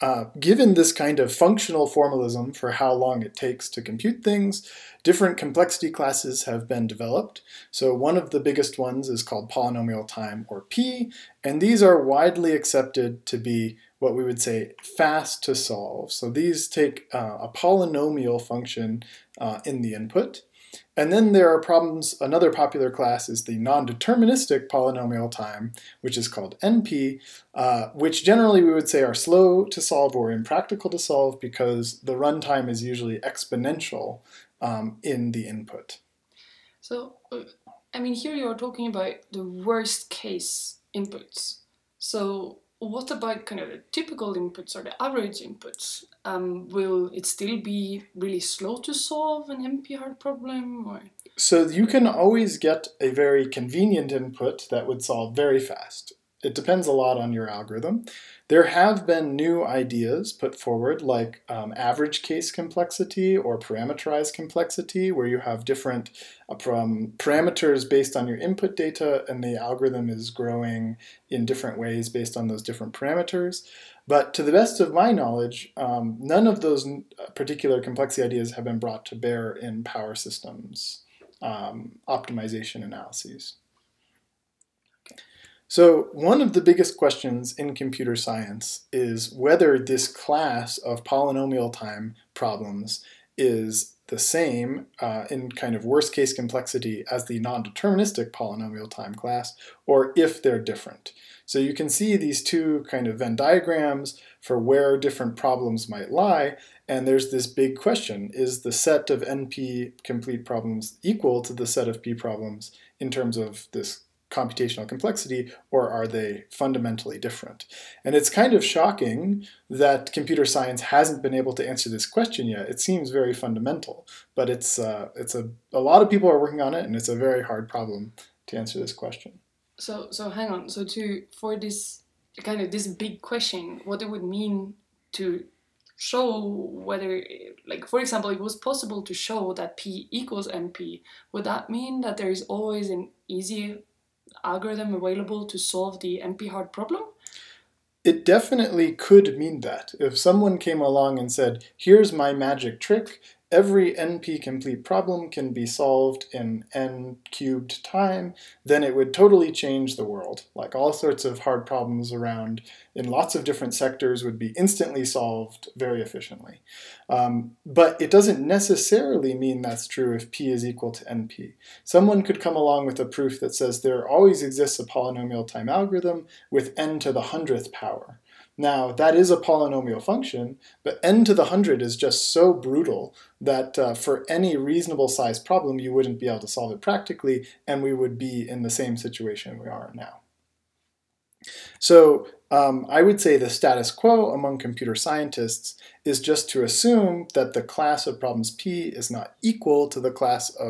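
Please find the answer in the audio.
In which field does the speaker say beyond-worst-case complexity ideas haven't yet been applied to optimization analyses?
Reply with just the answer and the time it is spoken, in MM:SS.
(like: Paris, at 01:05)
power systems, at 01:19.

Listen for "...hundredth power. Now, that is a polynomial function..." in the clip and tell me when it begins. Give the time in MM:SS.
02:57.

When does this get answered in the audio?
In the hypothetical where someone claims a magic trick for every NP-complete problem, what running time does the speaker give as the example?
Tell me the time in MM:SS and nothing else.
02:36.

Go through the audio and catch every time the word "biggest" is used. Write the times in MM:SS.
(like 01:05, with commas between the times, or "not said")
00:08, 01:26.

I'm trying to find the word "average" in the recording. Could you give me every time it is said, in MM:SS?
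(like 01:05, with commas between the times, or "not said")
00:45, 01:01.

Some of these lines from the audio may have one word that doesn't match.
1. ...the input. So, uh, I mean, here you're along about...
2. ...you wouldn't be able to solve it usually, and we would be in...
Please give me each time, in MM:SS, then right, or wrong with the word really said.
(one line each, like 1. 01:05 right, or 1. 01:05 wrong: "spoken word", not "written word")
1. 00:35 wrong: "talking", not "along"
2. 03:05 wrong: "practically", not "usually".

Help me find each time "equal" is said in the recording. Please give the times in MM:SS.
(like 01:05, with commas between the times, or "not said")
01:51, 02:20, 02:50, 03:19.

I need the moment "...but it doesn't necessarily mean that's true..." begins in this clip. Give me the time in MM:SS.
02:47.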